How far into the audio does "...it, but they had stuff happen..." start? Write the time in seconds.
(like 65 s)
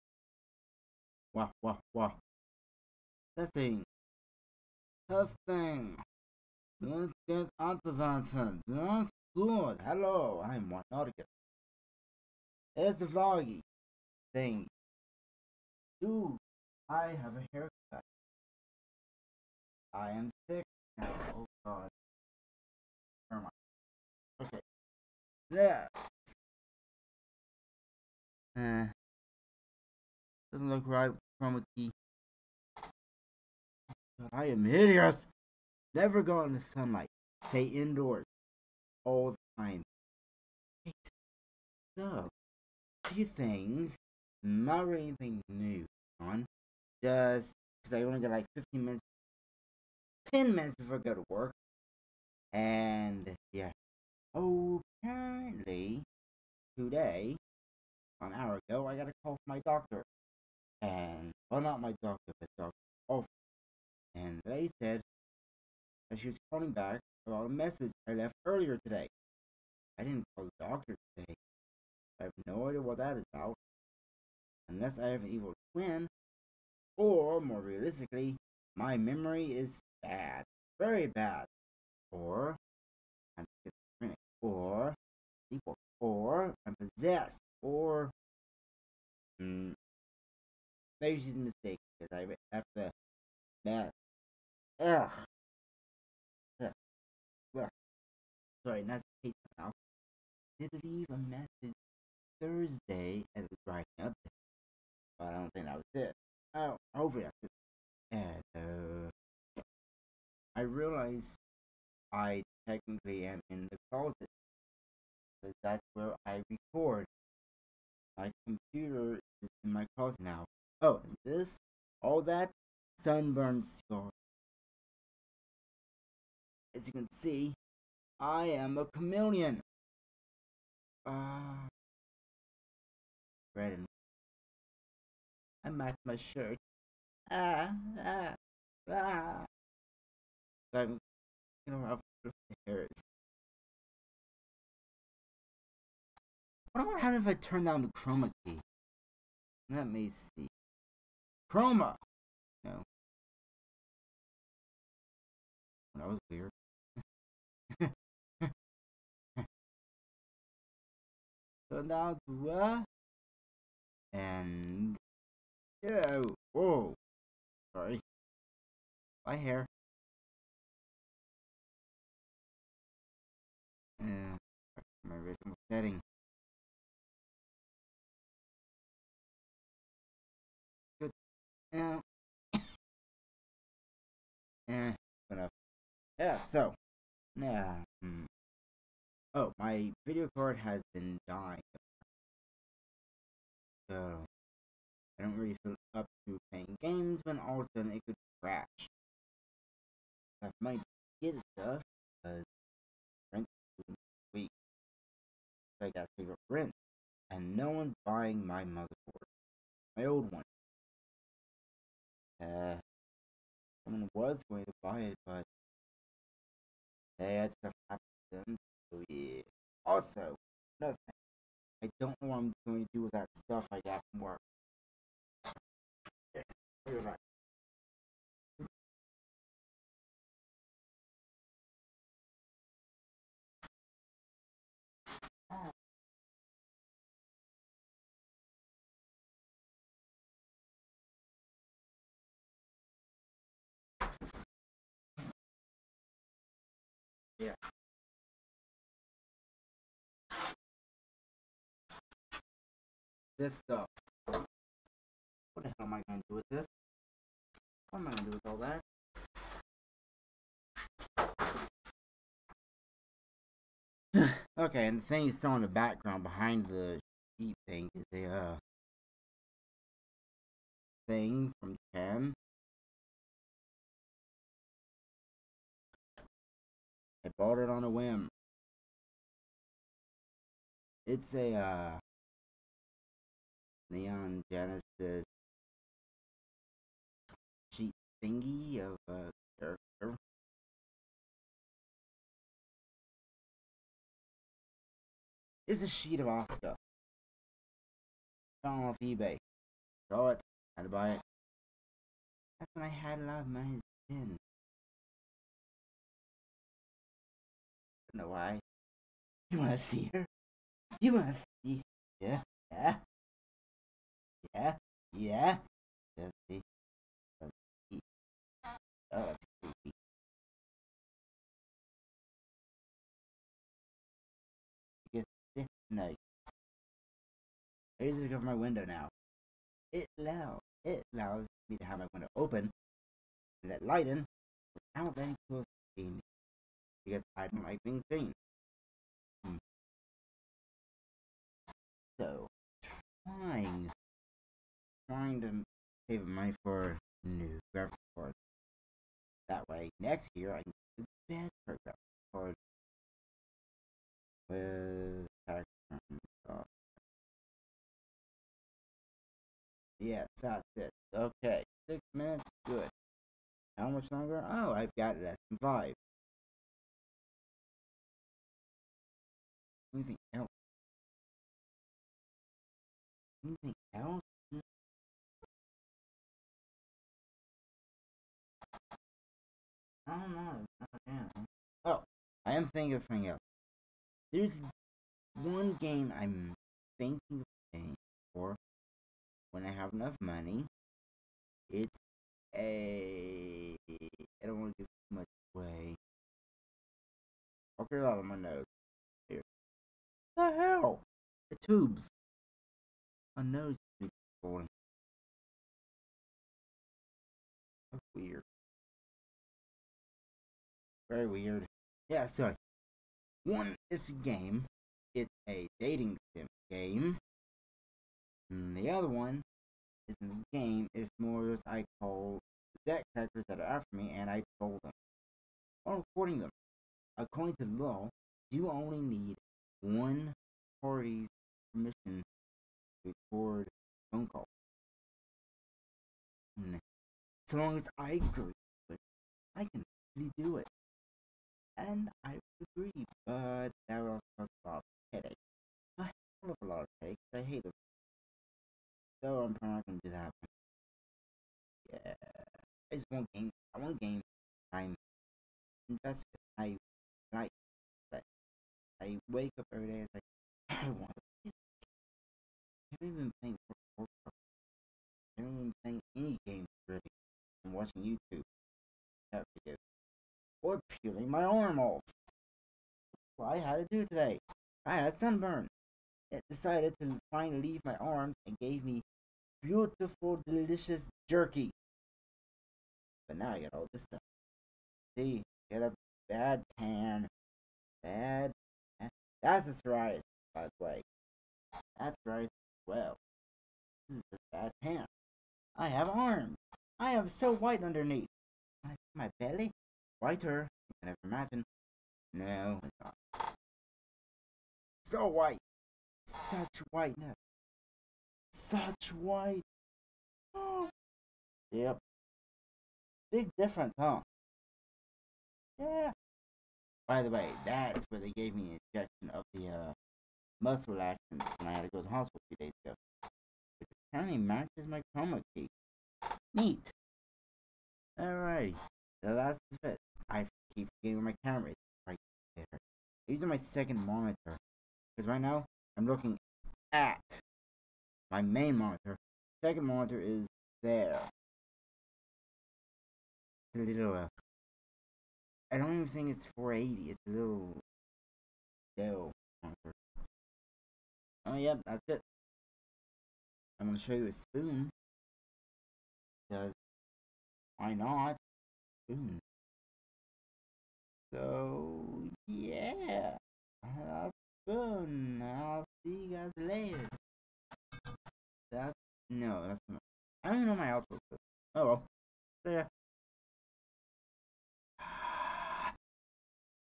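215 s.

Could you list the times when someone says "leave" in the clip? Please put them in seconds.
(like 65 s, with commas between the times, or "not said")
100 s, 477 s.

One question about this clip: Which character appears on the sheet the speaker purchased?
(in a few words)
Asuka.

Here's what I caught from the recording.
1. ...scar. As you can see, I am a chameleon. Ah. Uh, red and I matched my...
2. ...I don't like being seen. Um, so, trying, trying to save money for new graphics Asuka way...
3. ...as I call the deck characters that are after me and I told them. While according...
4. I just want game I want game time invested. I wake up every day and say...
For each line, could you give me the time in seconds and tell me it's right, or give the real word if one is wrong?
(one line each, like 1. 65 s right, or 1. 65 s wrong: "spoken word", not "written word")
1. 123 s right
2. 337 s wrong: "That", not "Asuka"
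3. 421 s wrong: "recording", not "according"
4. 452 s right.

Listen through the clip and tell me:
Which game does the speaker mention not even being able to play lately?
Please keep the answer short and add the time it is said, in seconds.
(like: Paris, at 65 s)
Warcraft, at 463 s.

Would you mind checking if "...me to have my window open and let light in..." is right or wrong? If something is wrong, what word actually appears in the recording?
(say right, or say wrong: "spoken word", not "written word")
right.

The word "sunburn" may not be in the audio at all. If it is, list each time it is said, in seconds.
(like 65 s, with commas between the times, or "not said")
122 s, 475 s.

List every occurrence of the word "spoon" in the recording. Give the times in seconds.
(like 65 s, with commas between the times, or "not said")
554 s, 559 s, 564 s.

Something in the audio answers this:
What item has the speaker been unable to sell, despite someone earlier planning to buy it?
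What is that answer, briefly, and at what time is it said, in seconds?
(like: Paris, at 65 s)
motherboard, at 208 s.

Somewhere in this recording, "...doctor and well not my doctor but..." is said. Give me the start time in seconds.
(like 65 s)
59 s.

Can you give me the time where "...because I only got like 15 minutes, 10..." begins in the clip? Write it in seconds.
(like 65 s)
47 s.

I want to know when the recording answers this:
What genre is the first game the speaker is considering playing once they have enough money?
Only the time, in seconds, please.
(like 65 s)
415 s.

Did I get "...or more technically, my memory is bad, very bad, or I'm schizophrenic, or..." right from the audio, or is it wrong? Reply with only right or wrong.
wrong.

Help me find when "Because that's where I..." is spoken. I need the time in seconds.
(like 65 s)
115 s.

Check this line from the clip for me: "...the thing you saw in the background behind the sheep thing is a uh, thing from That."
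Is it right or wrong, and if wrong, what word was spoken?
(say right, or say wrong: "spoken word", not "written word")
wrong: "Japan", not "That".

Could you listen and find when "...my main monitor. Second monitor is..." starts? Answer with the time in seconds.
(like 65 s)
538 s.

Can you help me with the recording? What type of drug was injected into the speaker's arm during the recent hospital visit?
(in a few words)
muscle relaxant.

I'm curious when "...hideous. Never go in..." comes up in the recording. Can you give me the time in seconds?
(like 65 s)
34 s.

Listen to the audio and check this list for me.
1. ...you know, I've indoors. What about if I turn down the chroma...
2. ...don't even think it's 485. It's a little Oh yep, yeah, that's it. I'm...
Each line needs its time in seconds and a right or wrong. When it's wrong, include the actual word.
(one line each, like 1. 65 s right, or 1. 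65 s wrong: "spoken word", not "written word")
1. 141 s wrong: "hairs", not "indoors"
2. 545 s wrong: "480", not "485".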